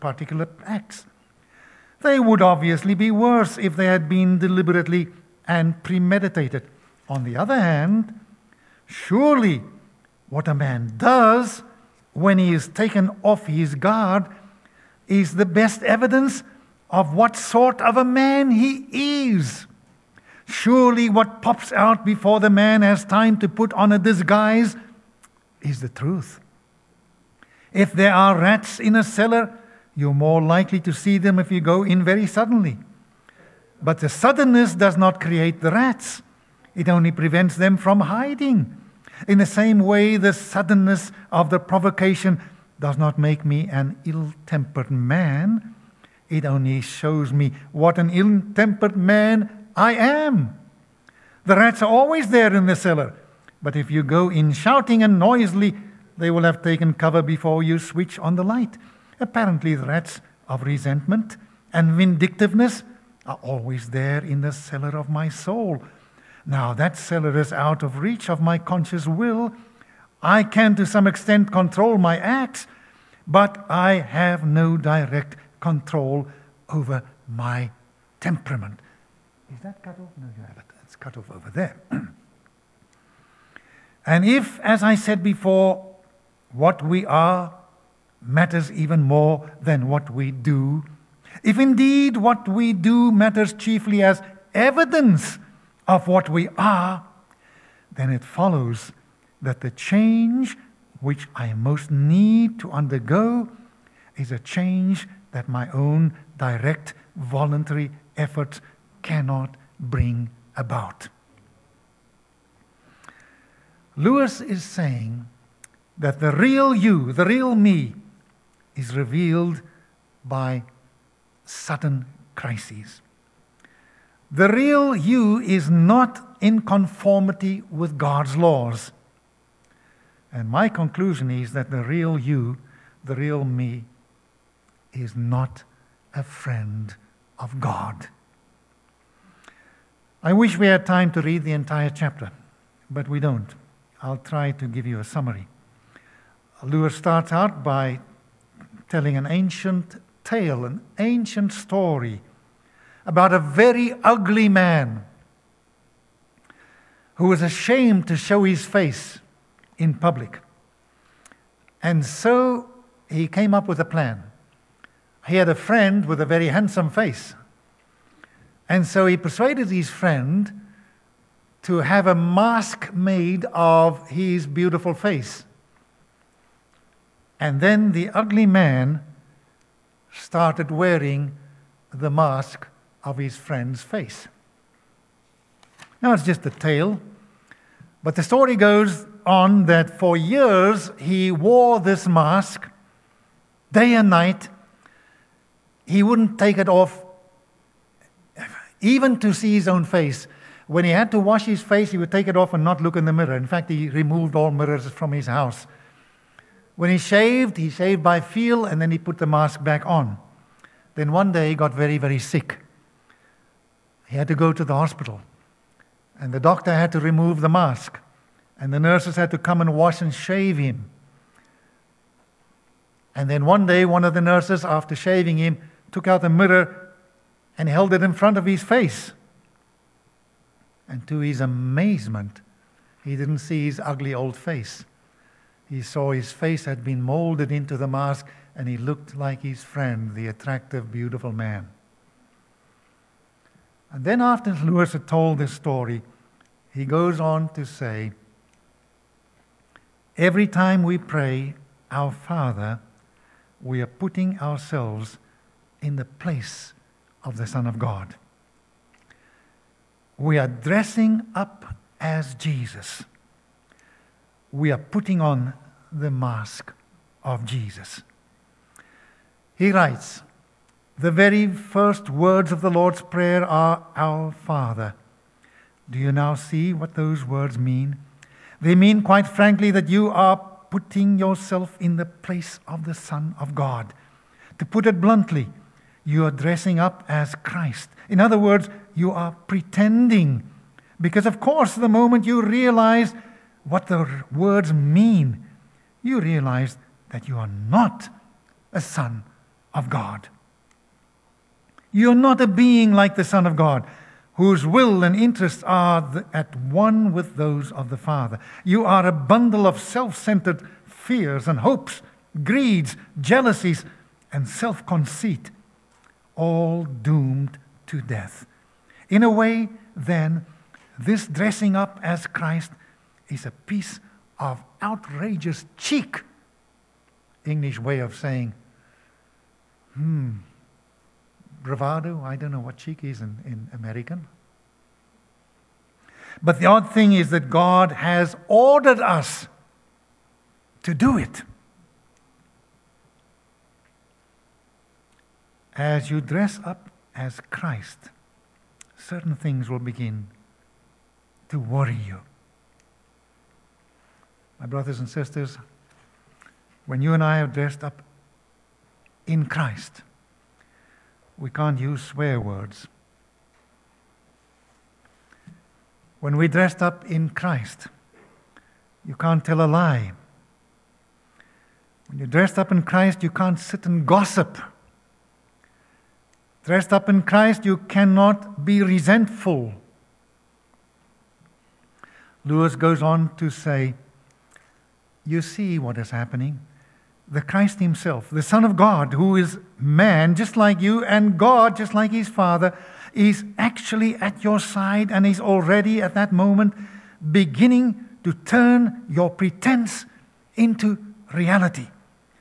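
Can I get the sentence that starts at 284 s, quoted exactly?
To put it bluntly, you are dressing up as Christ.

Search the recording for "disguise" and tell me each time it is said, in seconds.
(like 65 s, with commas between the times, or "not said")
23 s.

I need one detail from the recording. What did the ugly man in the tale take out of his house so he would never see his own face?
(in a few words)
All mirrors.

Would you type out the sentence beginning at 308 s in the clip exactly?
You are a bundle of self centered fears and hopes, greeds, jealousies, and self conceit, all doomed to death.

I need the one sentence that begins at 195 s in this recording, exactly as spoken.
He wouldn't take it off, even to see his own face.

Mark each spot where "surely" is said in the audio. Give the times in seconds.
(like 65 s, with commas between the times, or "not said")
8 s, 20 s.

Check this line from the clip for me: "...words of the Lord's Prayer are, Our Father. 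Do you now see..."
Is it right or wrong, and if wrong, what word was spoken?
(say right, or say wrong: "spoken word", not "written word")
right.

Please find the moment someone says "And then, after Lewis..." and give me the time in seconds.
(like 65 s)
243 s.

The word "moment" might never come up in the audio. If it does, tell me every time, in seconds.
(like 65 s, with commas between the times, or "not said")
291 s, 396 s.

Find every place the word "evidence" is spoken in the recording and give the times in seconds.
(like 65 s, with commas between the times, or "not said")
15 s, 94 s.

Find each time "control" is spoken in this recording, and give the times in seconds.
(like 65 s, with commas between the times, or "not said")
71 s, 75 s.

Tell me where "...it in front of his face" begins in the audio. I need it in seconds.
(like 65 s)
227 s.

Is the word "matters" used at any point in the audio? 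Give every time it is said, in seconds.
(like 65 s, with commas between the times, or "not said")
88 s, 93 s.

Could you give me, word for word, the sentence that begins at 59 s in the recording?
Apparently, the rats of resentment and vindictiveness are always there in the cellar of my soul.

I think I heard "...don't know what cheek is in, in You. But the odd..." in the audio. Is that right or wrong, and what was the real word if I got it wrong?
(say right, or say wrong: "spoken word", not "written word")
wrong: "American", not "You".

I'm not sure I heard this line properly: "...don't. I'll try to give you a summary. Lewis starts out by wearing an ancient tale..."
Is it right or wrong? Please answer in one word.
wrong.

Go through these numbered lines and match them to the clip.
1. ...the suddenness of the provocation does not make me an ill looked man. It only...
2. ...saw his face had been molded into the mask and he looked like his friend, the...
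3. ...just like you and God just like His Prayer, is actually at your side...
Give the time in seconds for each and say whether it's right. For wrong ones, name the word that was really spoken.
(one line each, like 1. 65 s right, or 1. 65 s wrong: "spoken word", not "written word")
1. 40 s wrong: "tempered", not "looked"
2. 235 s right
3. 390 s wrong: "Father", not "Prayer".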